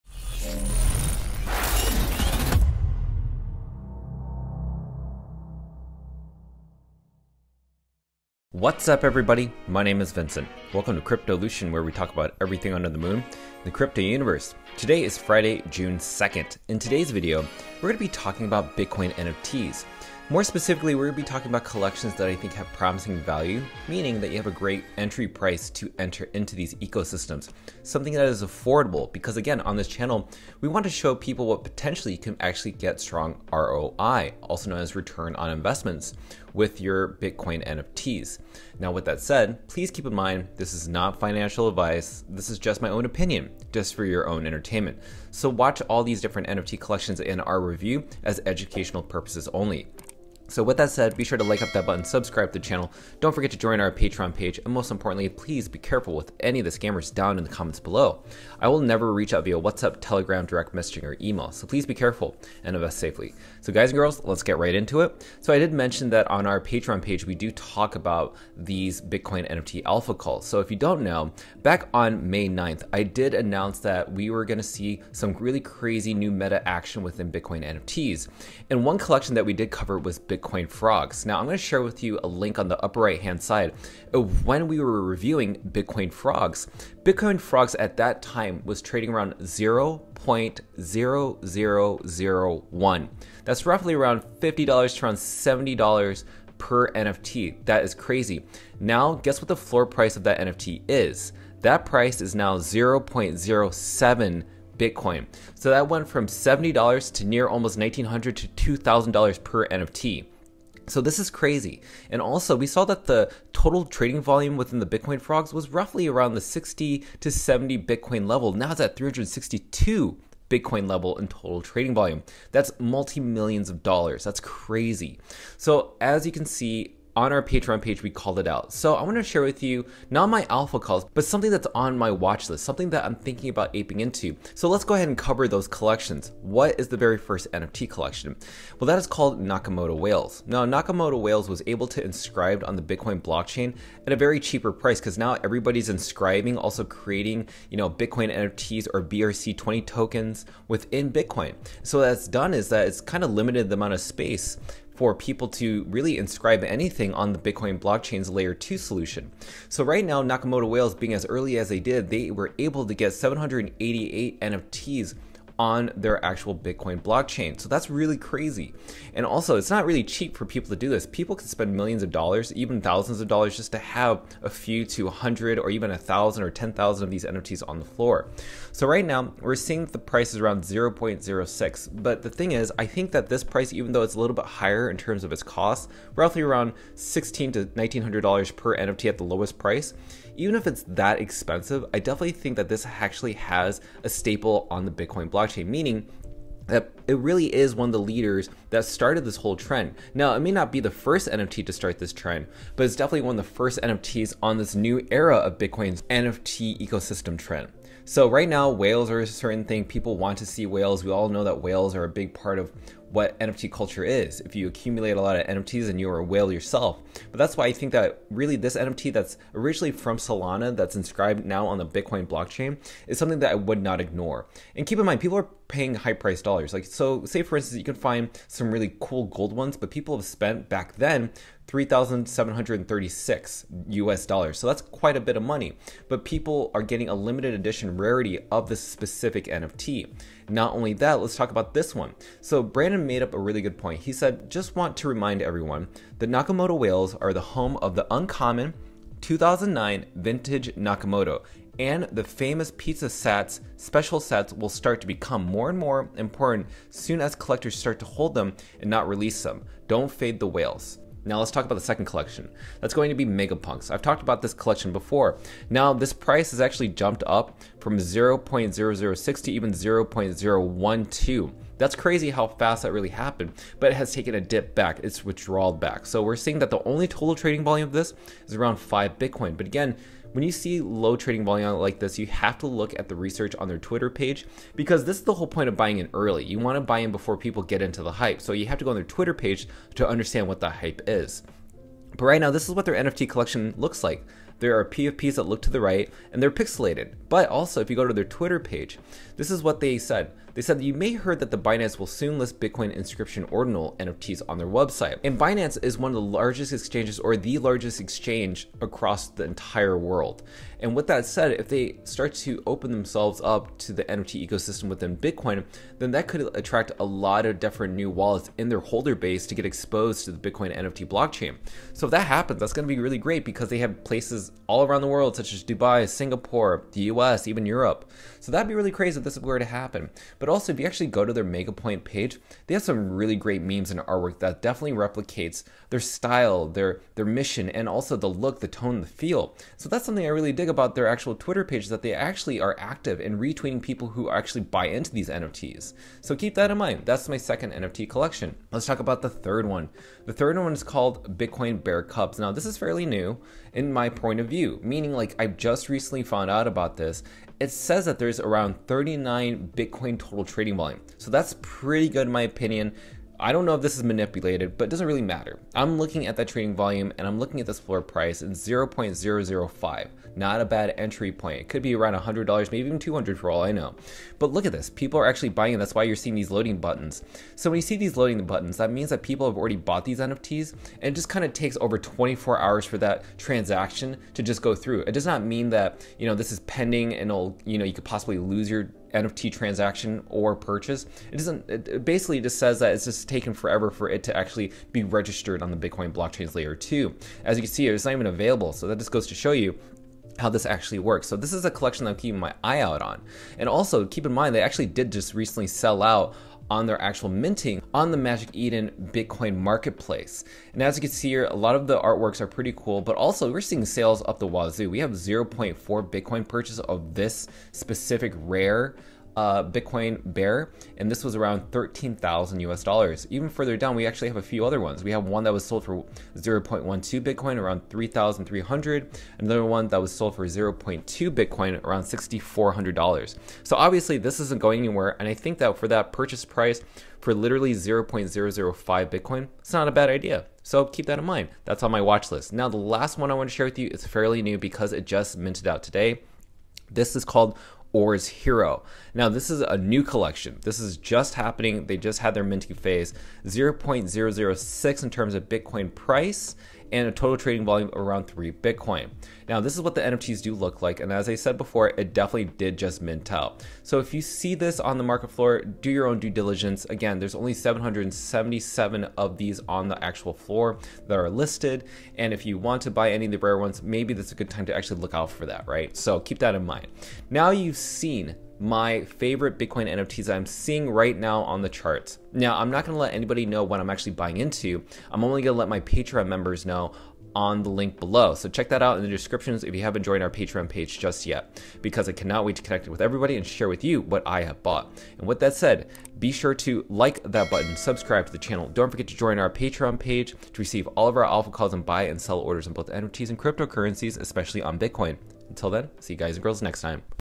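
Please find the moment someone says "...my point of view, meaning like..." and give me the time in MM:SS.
05:53.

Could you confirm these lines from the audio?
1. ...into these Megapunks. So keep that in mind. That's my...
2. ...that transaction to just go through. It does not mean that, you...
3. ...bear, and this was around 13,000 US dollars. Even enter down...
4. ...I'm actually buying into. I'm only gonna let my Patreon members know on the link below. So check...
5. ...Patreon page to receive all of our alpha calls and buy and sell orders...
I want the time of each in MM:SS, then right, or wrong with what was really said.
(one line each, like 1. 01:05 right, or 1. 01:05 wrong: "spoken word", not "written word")
1. 05:44 wrong: "NFTs", not "Megapunks"
2. 06:22 right
3. 07:00 wrong: "further", not "enter"
4. 08:03 right
5. 08:19 right.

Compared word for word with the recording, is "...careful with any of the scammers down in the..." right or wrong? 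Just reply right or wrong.
right.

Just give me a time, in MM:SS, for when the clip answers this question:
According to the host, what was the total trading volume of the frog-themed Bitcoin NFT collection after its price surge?
01:58.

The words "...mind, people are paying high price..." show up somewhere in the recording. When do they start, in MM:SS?
03:45.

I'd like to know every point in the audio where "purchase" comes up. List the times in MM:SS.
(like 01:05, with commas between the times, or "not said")
06:30, 06:56, 07:16.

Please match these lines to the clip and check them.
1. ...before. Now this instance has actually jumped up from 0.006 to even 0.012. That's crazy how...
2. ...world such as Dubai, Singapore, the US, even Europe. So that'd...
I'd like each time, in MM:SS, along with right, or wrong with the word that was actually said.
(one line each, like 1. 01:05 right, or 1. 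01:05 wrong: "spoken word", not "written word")
1. 04:24 wrong: "price", not "instance"
2. 05:25 right.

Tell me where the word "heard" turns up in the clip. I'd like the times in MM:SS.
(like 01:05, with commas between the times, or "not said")
05:01.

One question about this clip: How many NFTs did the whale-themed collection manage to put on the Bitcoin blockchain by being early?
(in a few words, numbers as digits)
788.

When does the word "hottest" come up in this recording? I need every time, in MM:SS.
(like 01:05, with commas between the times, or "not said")
not said.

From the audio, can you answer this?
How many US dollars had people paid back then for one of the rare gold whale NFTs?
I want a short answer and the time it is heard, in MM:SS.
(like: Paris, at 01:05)
$3,736, at 03:51.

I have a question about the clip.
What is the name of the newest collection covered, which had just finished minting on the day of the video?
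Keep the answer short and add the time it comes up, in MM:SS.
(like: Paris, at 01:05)
Ordz Hero, at 07:27.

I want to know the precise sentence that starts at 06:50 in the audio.
And as you can see here, a lot of the artworks are pretty cool, but also we're seeing sales up the wazoo.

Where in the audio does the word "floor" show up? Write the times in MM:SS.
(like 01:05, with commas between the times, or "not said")
01:39, 02:57, 06:07, 07:45, 07:50.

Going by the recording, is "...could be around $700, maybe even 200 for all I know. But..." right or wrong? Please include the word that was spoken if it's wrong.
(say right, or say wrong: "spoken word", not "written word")
wrong: "100", not "700".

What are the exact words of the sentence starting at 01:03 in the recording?
So guys and girls, let's get right into it.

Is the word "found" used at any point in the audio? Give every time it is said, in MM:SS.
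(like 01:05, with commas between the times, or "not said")
05:56.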